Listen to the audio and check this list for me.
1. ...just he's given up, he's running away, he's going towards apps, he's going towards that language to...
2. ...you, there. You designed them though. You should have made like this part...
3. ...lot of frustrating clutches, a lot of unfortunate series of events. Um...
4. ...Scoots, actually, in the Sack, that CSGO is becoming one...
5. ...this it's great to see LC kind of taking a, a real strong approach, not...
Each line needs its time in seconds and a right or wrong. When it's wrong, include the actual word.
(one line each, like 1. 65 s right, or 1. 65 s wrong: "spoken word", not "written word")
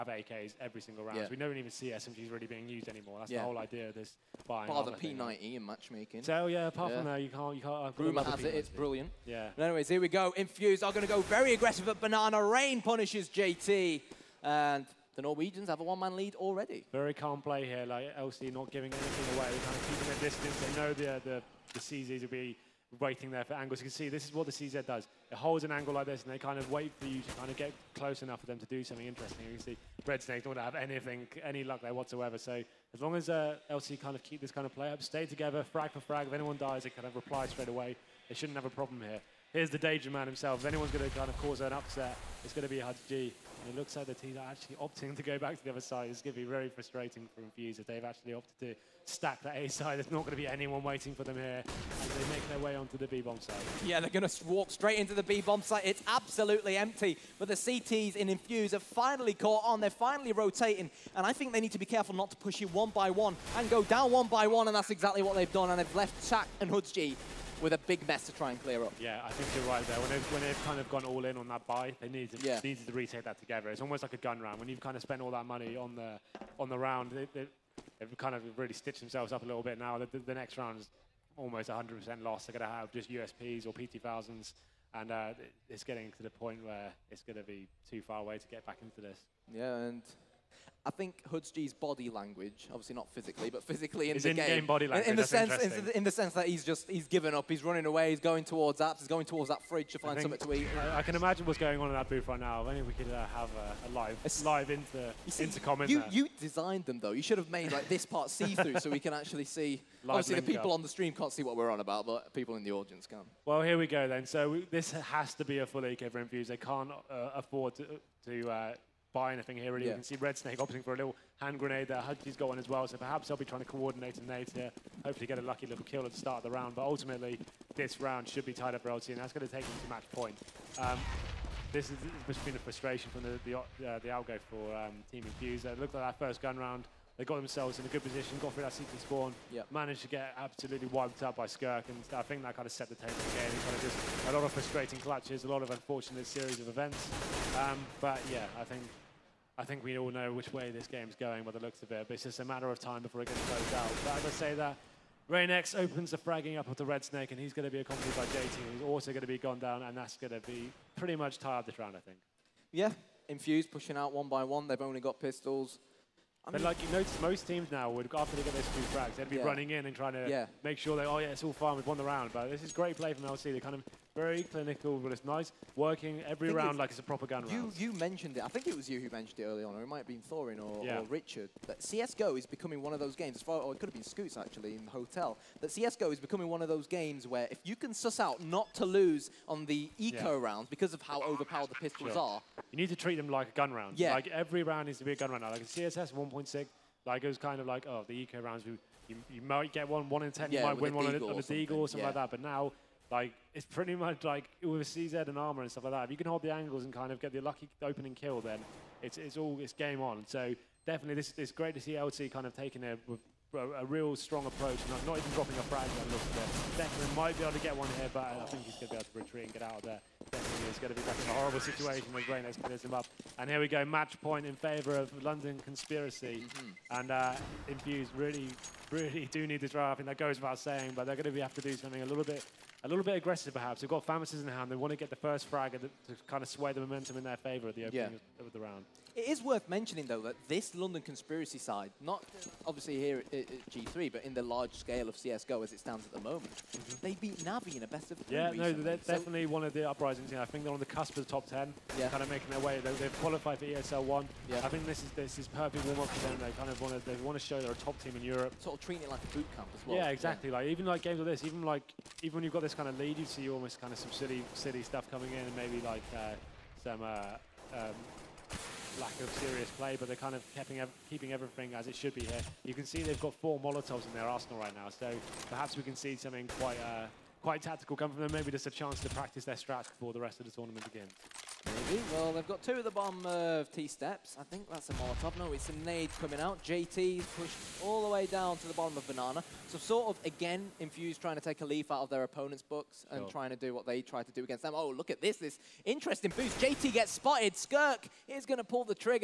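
1. 96 s wrong: "fridge", not "language"
2. 105 s right
3. 144 s right
4. 184 s wrong: "Hotel", not "Sack"
5. 211 s right.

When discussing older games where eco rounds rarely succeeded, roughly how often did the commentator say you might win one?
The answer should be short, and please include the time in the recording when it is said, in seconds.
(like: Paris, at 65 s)
1 in 10, at 200 s.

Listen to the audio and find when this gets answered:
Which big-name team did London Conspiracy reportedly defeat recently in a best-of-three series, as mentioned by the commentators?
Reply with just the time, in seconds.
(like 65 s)
247 s.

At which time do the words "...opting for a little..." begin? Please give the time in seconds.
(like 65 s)
120 s.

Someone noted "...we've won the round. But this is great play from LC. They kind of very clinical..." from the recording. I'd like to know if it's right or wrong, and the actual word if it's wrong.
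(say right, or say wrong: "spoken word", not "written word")
right.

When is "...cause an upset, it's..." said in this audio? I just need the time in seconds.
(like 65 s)
41 s.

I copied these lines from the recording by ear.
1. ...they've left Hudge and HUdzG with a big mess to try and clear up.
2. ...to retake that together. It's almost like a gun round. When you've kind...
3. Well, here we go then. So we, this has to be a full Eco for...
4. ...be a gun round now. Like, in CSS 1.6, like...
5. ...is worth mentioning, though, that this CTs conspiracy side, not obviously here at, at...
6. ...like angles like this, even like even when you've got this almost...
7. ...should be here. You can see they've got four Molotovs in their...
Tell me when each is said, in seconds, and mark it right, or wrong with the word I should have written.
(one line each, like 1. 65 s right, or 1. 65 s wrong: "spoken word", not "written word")
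1. 65 s wrong: "Sack", not "Hudge"
2. 72 s right
3. 113 s right
4. 195 s right
5. 239 s wrong: "London", not "CTs"
6. 260 s wrong: "games", not "angles"
7. 271 s right.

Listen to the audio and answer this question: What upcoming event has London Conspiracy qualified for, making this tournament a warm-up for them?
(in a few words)
ESL 1.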